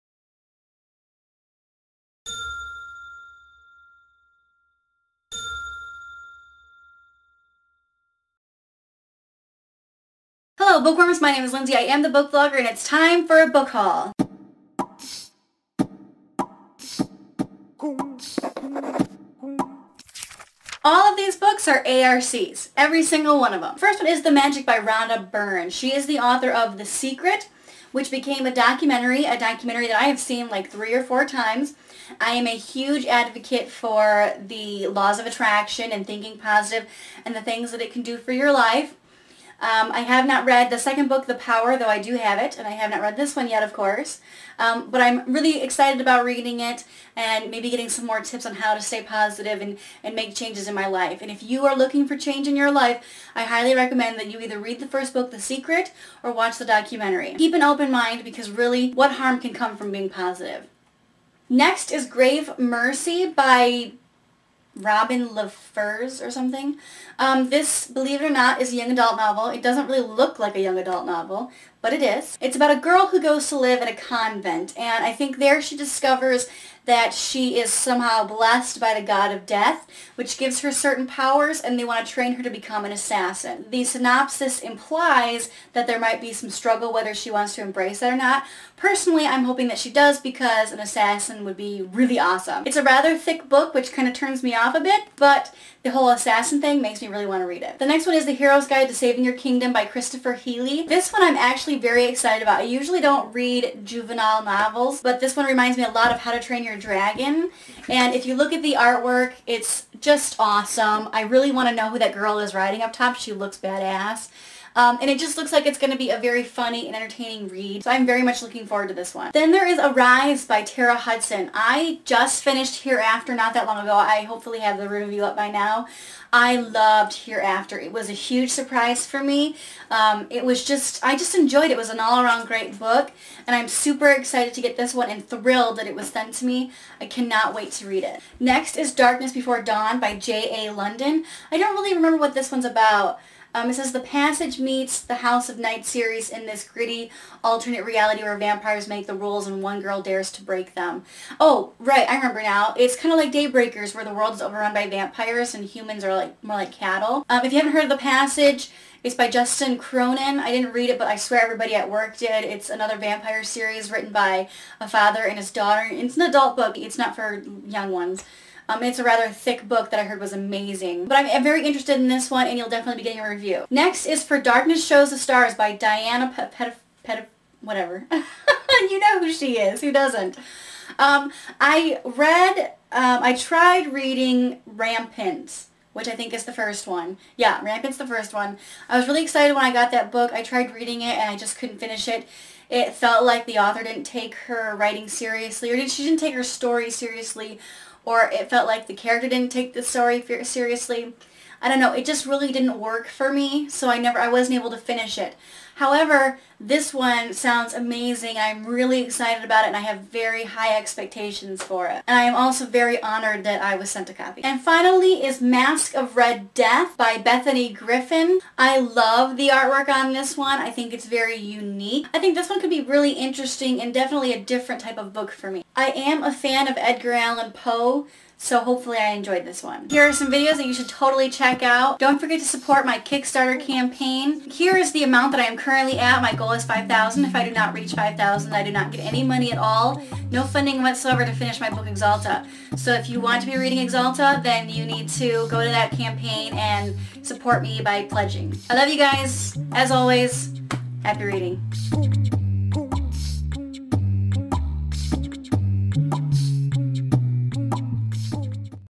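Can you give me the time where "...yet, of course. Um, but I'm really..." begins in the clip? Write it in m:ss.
0:43.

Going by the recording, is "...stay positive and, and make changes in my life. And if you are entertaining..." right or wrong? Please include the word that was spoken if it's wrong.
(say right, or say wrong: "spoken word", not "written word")
wrong: "looking", not "entertaining".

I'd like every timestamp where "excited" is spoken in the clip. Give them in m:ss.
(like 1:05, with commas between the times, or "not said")
0:45, 1:42, 2:14, 3:09, 3:29.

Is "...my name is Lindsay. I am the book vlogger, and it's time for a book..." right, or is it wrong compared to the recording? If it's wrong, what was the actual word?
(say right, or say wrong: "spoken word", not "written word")
right.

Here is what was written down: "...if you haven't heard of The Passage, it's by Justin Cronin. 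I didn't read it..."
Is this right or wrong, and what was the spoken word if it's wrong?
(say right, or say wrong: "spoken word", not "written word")
right.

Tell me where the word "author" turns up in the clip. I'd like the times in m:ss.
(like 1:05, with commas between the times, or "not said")
0:26, 3:13.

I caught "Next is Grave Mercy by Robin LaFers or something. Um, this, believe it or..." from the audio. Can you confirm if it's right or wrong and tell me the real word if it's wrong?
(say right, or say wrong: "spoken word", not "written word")
right.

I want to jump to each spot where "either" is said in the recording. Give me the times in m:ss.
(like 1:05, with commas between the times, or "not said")
0:54.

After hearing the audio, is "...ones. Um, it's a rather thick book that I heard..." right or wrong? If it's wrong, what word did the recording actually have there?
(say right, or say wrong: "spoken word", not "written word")
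right.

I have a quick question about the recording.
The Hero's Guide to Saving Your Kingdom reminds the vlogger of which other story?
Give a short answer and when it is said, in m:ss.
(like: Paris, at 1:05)
How to Train Your Dragon, at 1:46.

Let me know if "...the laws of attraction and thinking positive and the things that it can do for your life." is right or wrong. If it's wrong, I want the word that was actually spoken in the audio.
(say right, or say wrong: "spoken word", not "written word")
right.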